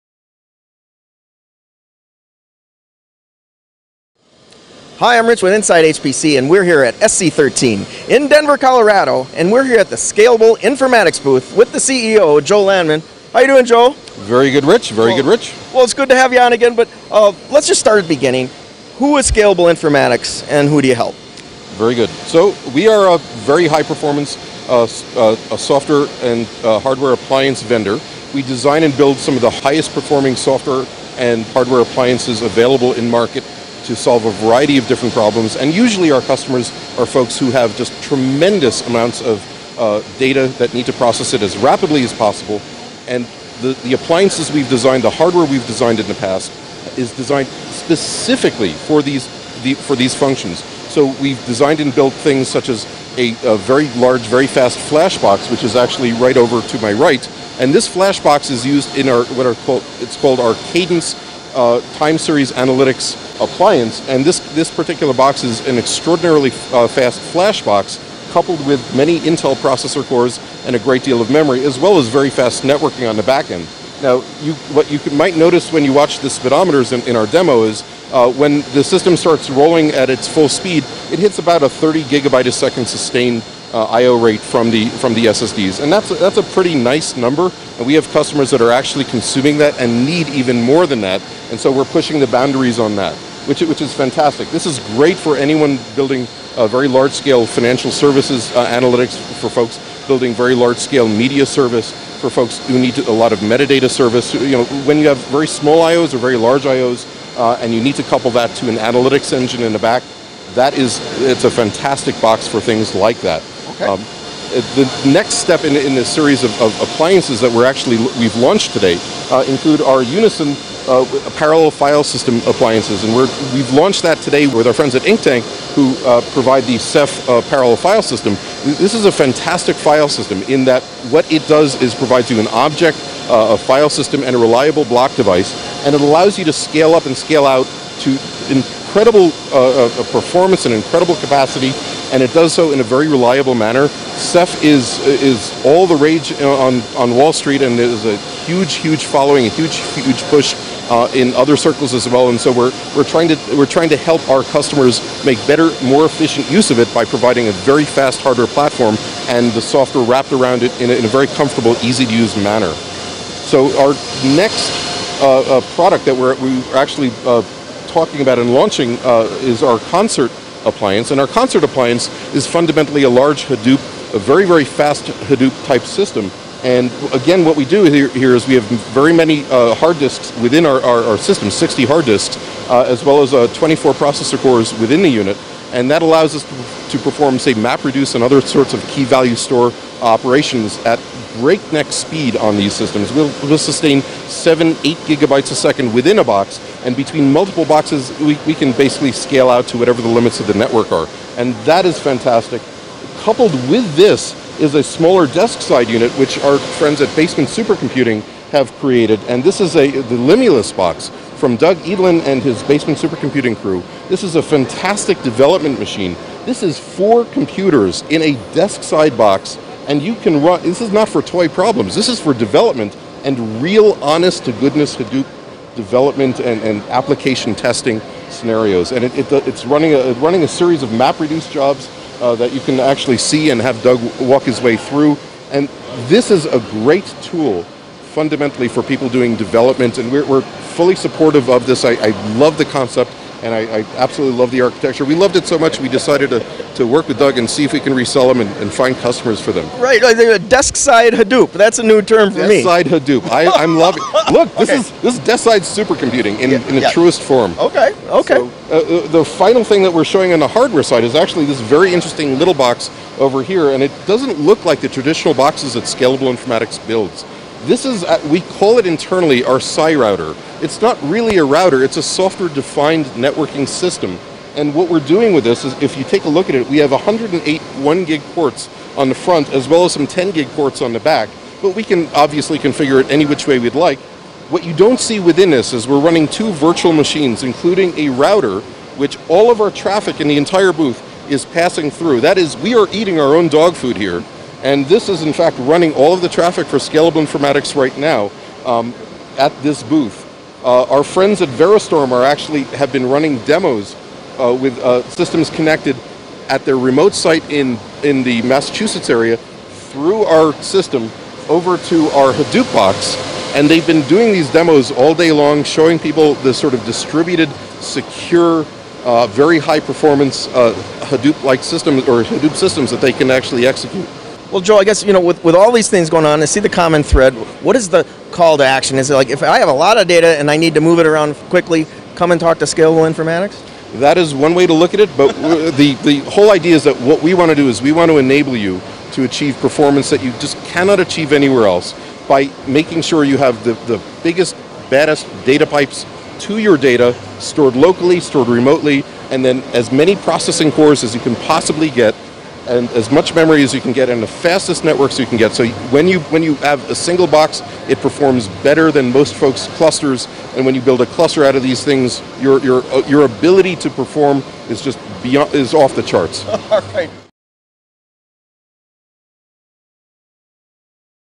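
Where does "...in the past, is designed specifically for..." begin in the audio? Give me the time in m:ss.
0:45.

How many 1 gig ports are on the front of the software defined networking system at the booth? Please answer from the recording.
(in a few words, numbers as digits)
108.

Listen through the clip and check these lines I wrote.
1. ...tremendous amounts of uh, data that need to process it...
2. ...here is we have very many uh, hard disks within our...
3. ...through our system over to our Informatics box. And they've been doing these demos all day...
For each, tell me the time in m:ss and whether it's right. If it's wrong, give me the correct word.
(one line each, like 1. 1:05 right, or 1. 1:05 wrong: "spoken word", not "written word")
1. 0:38 right
2. 2:58 right
3. 5:09 wrong: "Hadoop", not "Informatics".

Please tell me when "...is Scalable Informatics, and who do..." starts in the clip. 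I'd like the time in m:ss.
0:19.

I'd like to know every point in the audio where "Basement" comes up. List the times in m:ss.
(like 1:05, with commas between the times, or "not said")
3:27, 3:32.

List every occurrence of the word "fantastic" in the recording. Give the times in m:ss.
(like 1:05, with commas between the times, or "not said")
1:33, 1:51, 2:09, 3:21, 3:34.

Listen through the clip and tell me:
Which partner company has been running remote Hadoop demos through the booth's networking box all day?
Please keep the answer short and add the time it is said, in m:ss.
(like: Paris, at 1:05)
Verastorm, at 5:01.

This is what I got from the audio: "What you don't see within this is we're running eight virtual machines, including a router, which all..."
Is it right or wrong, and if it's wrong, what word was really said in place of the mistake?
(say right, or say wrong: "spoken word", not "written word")
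wrong: "two", not "eight".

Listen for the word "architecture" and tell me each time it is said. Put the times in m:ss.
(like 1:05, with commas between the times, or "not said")
4:04.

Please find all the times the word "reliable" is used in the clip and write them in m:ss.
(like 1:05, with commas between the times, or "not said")
2:14, 2:23.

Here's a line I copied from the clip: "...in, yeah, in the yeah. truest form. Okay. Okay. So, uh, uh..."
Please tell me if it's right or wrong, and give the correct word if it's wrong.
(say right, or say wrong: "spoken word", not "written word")
right.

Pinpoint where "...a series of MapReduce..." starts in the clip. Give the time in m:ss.
3:50.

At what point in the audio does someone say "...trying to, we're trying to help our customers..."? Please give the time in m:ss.
2:33.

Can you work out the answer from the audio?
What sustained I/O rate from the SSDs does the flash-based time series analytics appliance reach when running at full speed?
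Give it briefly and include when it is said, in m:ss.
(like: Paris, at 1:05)
30 gigabytes a second, at 1:21.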